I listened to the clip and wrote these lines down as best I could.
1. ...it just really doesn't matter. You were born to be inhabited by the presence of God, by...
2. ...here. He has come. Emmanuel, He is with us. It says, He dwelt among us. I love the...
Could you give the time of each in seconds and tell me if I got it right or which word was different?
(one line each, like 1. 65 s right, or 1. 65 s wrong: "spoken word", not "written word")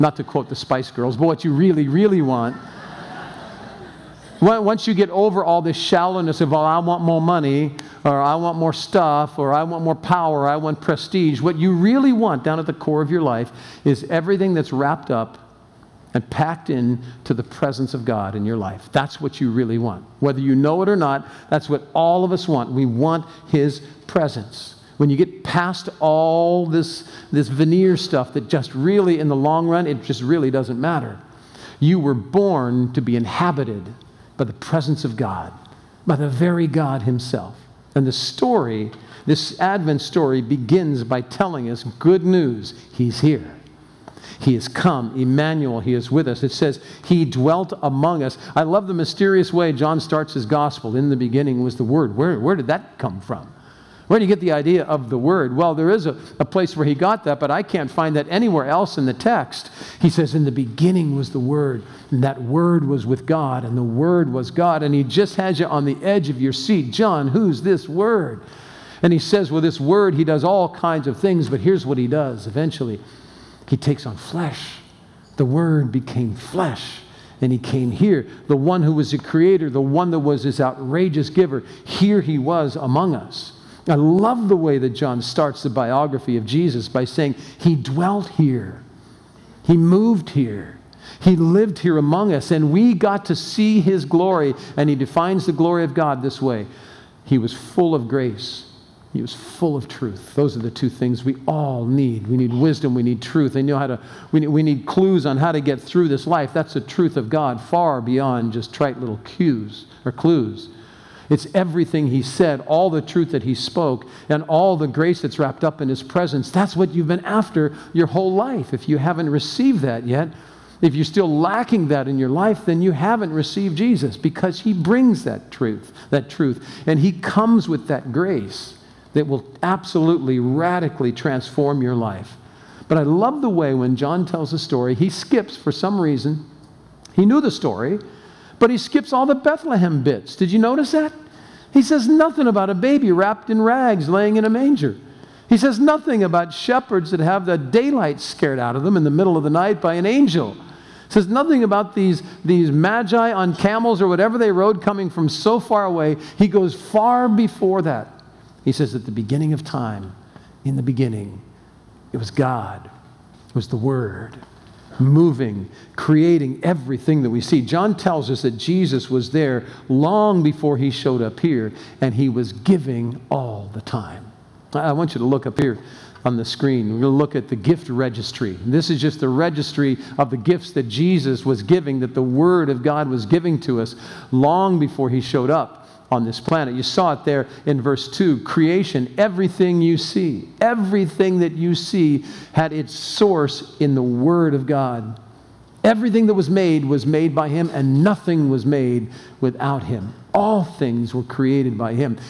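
1. 29 s right
2. 43 s right.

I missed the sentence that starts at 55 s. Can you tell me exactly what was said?
Well, there is a, a place where he got that, but I can't find that anywhere else in the text.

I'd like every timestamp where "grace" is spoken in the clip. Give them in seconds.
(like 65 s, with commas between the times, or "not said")
98 s, 114 s, 128 s.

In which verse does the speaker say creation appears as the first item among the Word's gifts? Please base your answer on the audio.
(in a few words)
2.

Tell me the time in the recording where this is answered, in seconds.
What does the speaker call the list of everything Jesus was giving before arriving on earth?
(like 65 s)
177 s.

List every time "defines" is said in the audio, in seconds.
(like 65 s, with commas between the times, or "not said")
94 s.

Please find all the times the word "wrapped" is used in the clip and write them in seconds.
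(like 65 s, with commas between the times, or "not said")
14 s, 115 s, 143 s.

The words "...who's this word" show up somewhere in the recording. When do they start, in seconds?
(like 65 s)
67 s.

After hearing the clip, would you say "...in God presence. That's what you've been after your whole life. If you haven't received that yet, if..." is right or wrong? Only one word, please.
wrong.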